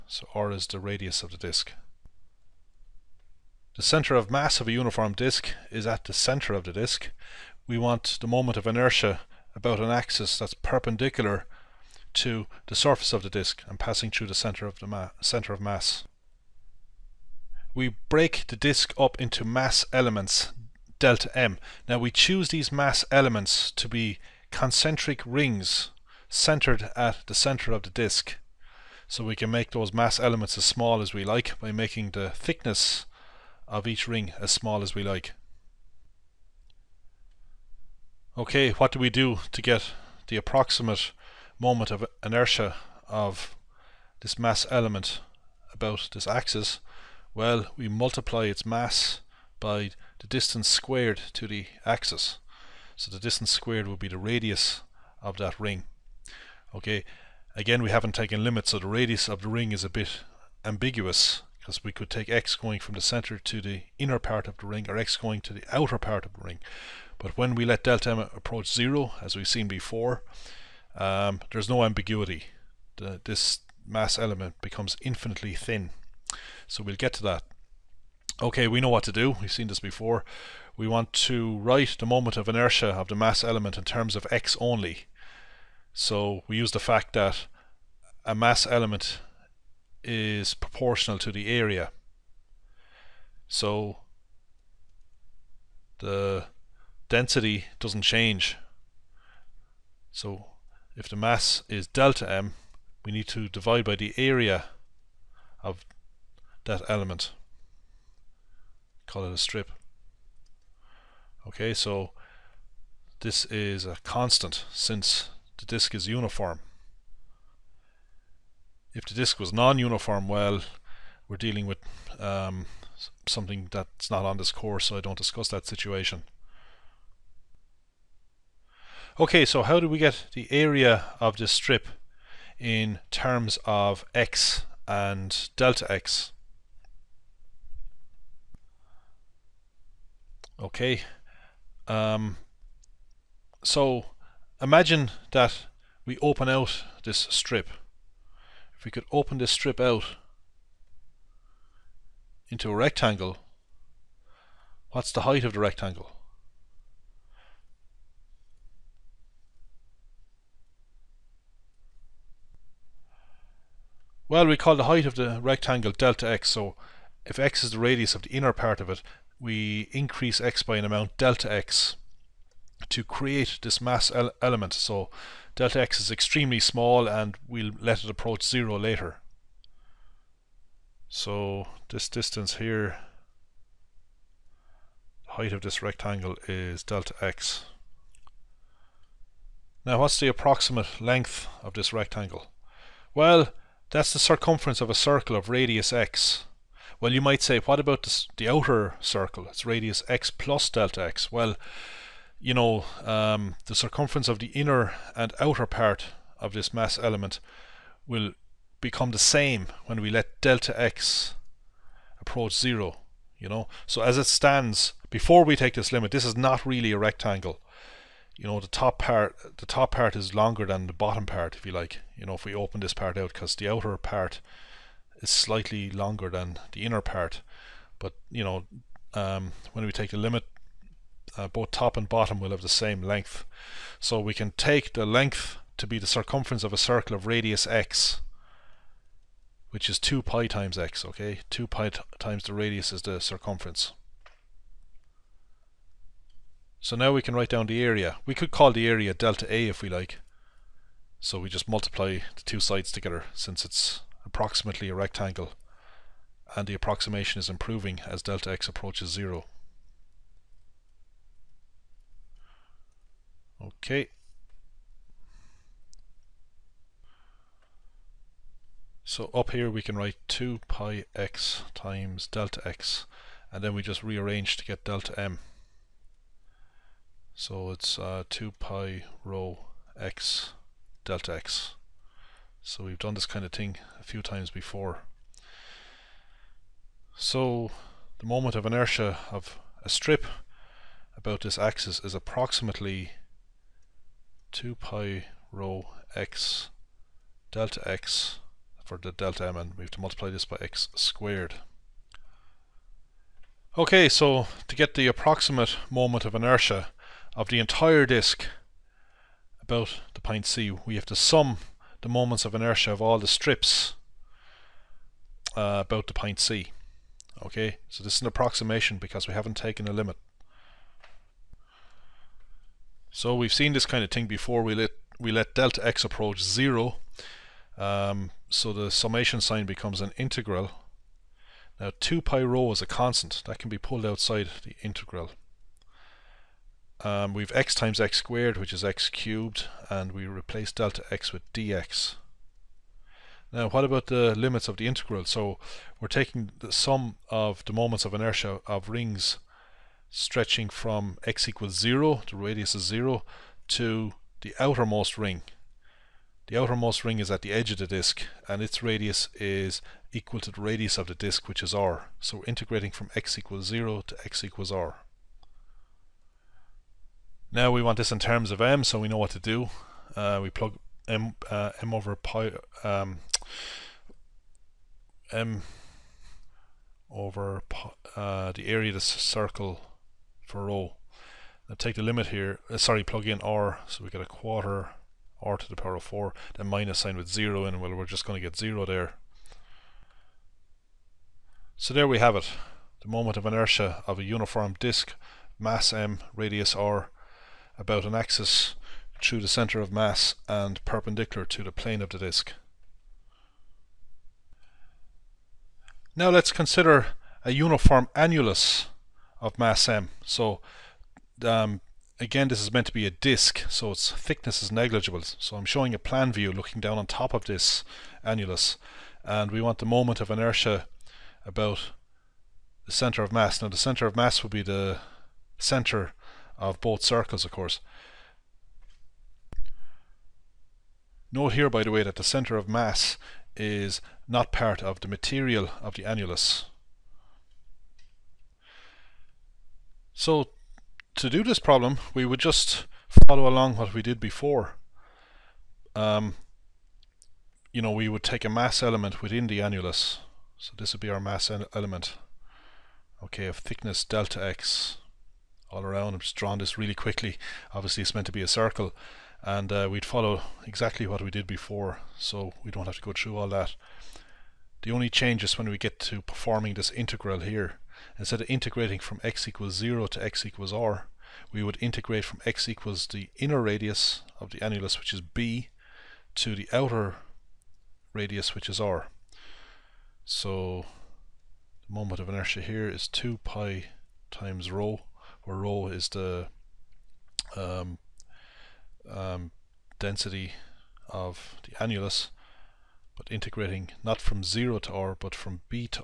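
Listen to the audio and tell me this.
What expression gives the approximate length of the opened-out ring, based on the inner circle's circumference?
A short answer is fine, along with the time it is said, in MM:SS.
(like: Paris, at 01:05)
2 pi x, at 03:59.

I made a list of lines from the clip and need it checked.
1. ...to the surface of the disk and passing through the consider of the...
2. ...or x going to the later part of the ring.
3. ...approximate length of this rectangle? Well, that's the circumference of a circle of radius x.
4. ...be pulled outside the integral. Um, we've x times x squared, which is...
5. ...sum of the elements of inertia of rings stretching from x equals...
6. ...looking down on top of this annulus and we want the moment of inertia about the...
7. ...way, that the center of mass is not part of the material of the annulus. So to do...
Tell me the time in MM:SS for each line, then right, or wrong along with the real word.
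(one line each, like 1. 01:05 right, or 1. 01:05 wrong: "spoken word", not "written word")
1. 00:12 wrong: "center", not "consider"
2. 01:04 wrong: "outer", not "later"
3. 03:10 right
4. 05:33 right
5. 05:46 wrong: "moments", not "elements"
6. 06:56 right
7. 07:11 right.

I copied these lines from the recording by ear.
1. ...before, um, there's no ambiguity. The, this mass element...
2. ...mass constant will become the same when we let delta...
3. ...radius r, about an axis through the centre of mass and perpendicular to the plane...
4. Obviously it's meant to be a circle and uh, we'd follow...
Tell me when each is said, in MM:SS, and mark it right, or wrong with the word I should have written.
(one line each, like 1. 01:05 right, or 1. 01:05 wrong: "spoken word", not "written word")
1. 01:09 right
2. 03:26 wrong: "element", not "constant"
3. 06:36 right
4. 07:37 right.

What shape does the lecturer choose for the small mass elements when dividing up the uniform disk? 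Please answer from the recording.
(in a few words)
Concentric rings.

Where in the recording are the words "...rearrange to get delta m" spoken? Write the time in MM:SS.
04:34.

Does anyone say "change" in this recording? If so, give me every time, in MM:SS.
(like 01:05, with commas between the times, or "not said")
01:38, 07:45.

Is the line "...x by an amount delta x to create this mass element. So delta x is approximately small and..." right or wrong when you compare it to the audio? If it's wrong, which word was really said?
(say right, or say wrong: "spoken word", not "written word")
wrong: "extremely", not "approximately".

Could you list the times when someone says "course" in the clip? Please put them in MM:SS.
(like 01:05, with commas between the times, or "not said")
02:04, 07:07.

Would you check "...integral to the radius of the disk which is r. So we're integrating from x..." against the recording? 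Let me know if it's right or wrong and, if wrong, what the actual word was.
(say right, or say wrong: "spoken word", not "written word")
wrong: "equal", not "integral".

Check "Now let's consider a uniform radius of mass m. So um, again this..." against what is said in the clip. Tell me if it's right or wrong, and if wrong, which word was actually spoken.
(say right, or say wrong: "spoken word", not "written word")
wrong: "annulus", not "radius".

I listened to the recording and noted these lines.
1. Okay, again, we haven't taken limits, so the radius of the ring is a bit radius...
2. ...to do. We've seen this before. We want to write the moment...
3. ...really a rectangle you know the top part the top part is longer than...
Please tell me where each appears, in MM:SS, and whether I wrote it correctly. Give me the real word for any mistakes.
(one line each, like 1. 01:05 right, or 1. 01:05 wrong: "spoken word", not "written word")
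1. 00:56 wrong: "ambiguous", not "radius"
2. 01:19 right
3. 03:36 right.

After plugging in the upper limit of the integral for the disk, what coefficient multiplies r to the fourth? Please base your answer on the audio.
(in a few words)
A quarter.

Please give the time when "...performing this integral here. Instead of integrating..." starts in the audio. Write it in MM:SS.
07:46.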